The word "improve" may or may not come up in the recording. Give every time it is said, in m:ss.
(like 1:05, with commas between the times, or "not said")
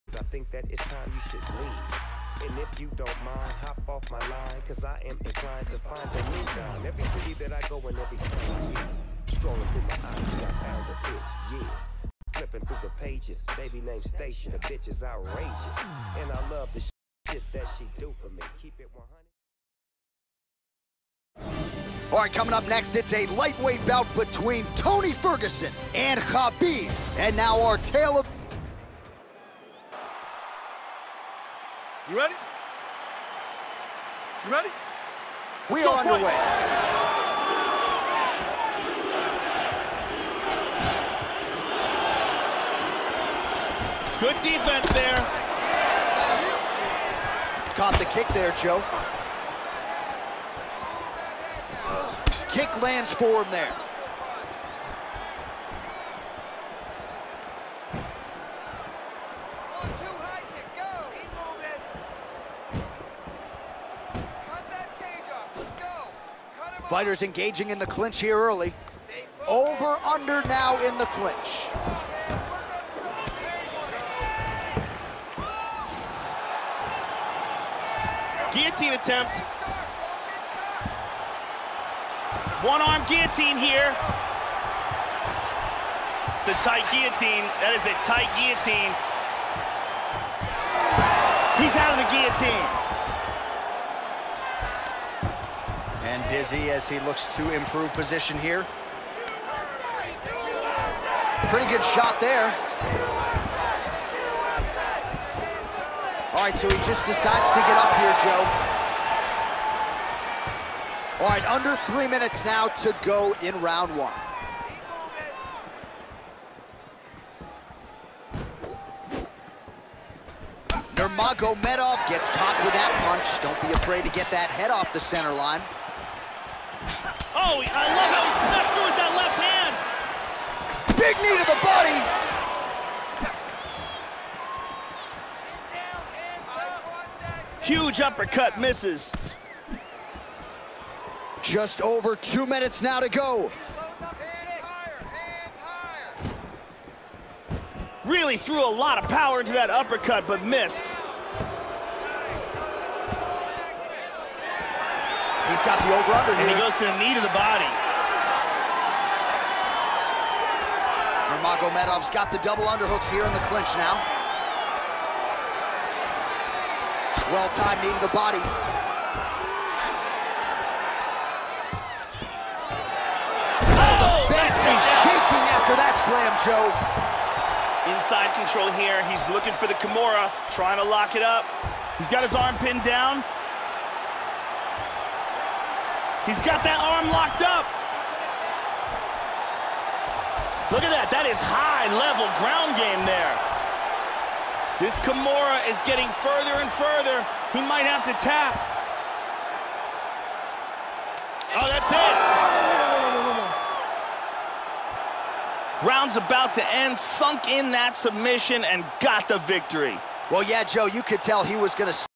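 1:37.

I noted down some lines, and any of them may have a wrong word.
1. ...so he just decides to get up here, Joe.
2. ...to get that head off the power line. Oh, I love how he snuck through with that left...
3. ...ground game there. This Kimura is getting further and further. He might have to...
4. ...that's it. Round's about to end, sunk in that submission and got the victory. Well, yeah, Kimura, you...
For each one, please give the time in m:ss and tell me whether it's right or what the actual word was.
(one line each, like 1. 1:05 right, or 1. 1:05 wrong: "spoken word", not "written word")
1. 1:46 right
2. 2:04 wrong: "center", not "power"
3. 3:12 right
4. 3:21 wrong: "Joe", not "Kimura".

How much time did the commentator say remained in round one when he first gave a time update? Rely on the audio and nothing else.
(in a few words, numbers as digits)
Under 3 minutes.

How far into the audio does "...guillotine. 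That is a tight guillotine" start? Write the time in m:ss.
1:26.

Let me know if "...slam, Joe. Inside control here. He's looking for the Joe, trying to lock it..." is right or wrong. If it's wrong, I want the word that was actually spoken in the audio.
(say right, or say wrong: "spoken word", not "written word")
wrong: "Kimura", not "Joe".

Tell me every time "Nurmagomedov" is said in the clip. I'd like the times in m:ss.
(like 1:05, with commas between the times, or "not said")
2:00, 2:41.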